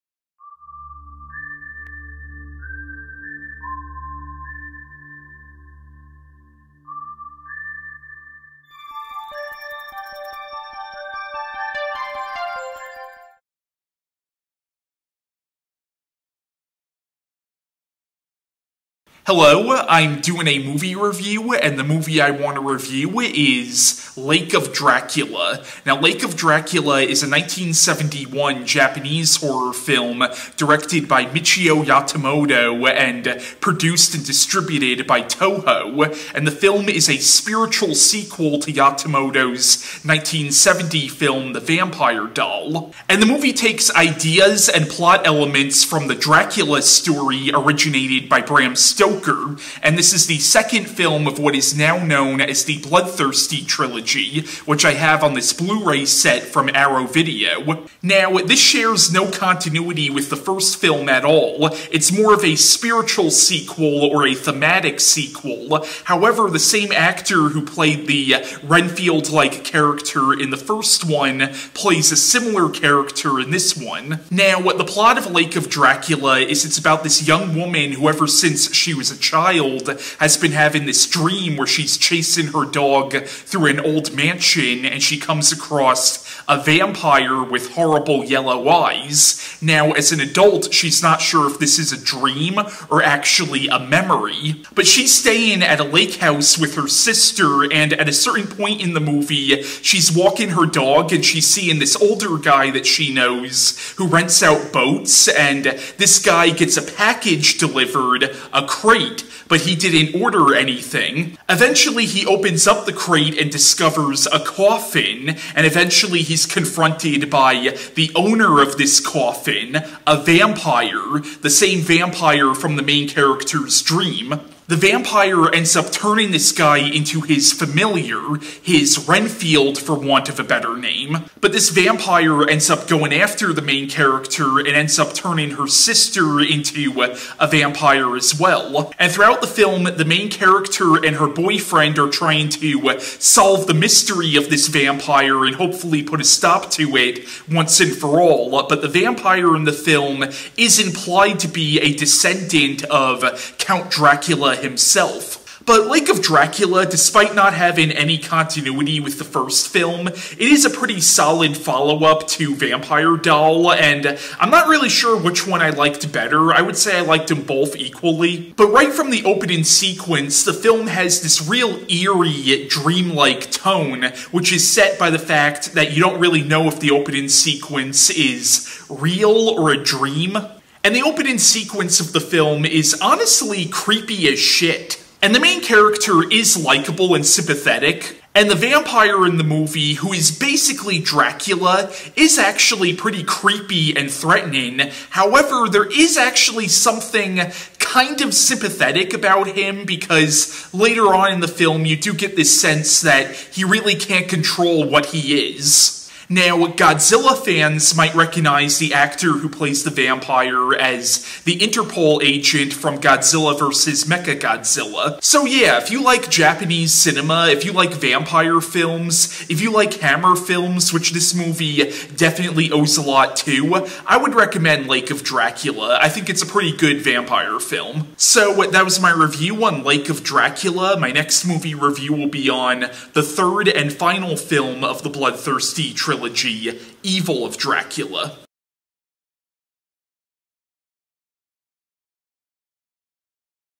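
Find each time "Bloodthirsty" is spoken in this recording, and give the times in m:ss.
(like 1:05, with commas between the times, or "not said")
0:52, 3:55.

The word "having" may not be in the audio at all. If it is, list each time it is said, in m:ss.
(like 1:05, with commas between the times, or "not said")
1:20, 2:37.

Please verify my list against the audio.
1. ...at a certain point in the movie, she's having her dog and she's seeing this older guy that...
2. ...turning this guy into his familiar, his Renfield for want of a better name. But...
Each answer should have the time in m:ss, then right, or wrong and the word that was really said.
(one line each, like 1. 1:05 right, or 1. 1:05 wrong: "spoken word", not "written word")
1. 1:37 wrong: "walking", not "having"
2. 2:05 right.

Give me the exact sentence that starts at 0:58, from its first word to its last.
Now, this shares no continuity with the first film at all.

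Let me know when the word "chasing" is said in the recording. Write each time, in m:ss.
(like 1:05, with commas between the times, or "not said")
1:21.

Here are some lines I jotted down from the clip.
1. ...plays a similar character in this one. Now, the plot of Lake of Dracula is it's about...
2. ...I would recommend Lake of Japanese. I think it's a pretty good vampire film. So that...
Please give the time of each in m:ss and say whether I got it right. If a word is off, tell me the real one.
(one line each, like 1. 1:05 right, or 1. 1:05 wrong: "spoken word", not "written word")
1. 1:11 right
2. 3:44 wrong: "Dracula", not "Japanese".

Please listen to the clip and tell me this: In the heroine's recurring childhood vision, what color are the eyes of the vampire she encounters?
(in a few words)
Yellow.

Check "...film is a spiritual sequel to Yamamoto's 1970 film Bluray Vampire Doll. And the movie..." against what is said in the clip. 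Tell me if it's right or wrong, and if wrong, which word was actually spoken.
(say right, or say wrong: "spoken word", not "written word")
wrong: "The", not "Bluray".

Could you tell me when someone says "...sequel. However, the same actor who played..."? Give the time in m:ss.
1:05.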